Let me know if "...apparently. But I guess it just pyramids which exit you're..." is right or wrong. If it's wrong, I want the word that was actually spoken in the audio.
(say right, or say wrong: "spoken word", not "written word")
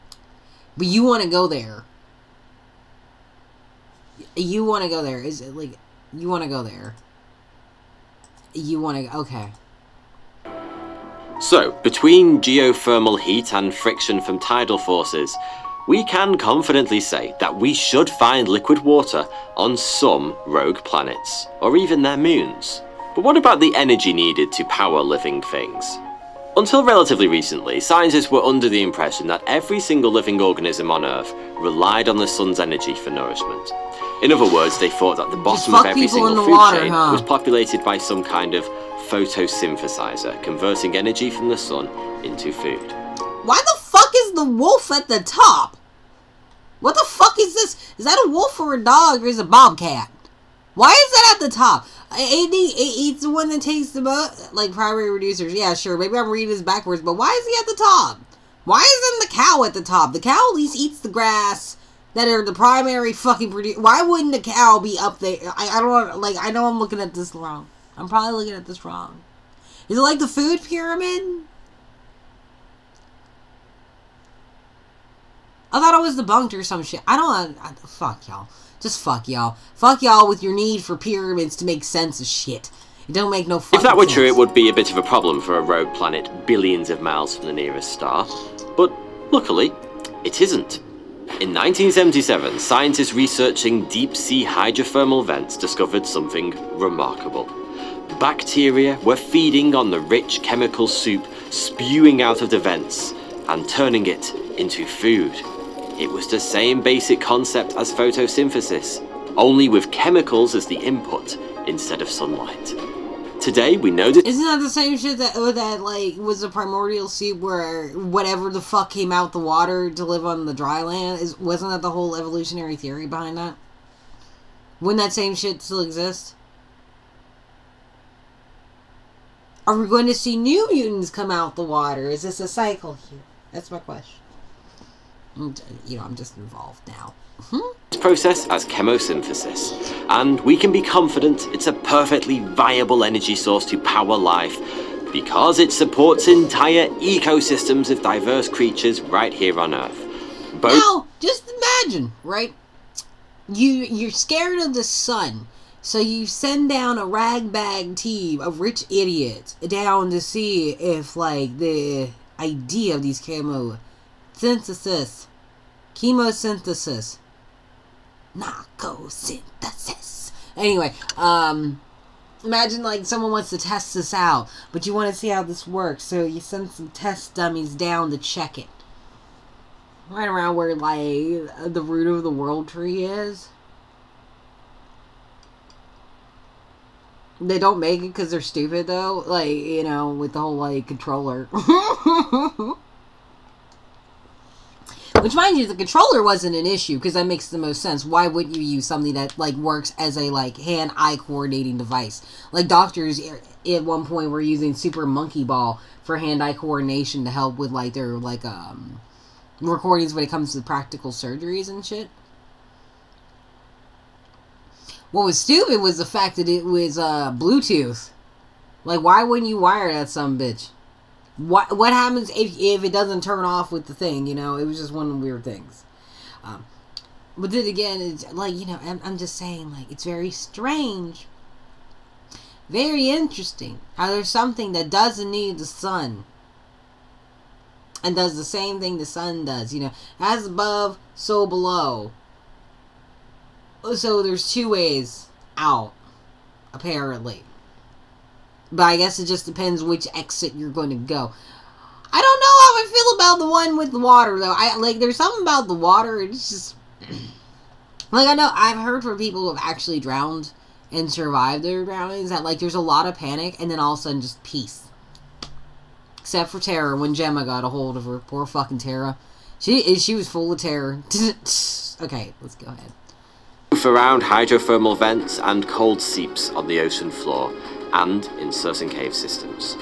wrong: "depends", not "pyramids".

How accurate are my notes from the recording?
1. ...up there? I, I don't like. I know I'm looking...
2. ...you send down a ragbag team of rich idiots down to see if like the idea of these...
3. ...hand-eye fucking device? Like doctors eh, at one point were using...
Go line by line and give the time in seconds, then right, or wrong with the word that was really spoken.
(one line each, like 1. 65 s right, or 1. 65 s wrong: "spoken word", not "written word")
1. 64 s right
2. 155 s right
3. 200 s wrong: "coordinating", not "fucking".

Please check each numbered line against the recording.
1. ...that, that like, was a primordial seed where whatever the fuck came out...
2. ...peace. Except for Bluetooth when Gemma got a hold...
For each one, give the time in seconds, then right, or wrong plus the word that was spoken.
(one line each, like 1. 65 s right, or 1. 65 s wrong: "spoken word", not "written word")
1. 115 s right
2. 264 s wrong: "Tara", not "Bluetooth".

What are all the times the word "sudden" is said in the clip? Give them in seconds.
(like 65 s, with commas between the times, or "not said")
264 s.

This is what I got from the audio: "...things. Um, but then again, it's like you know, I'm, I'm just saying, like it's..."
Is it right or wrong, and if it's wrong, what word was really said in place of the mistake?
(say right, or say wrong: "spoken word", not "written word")
right.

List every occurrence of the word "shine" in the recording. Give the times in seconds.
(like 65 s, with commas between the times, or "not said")
not said.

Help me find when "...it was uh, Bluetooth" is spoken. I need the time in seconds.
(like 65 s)
216 s.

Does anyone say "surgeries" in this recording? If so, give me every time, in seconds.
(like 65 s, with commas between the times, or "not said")
211 s.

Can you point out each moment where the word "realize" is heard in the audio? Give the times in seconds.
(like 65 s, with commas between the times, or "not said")
not said.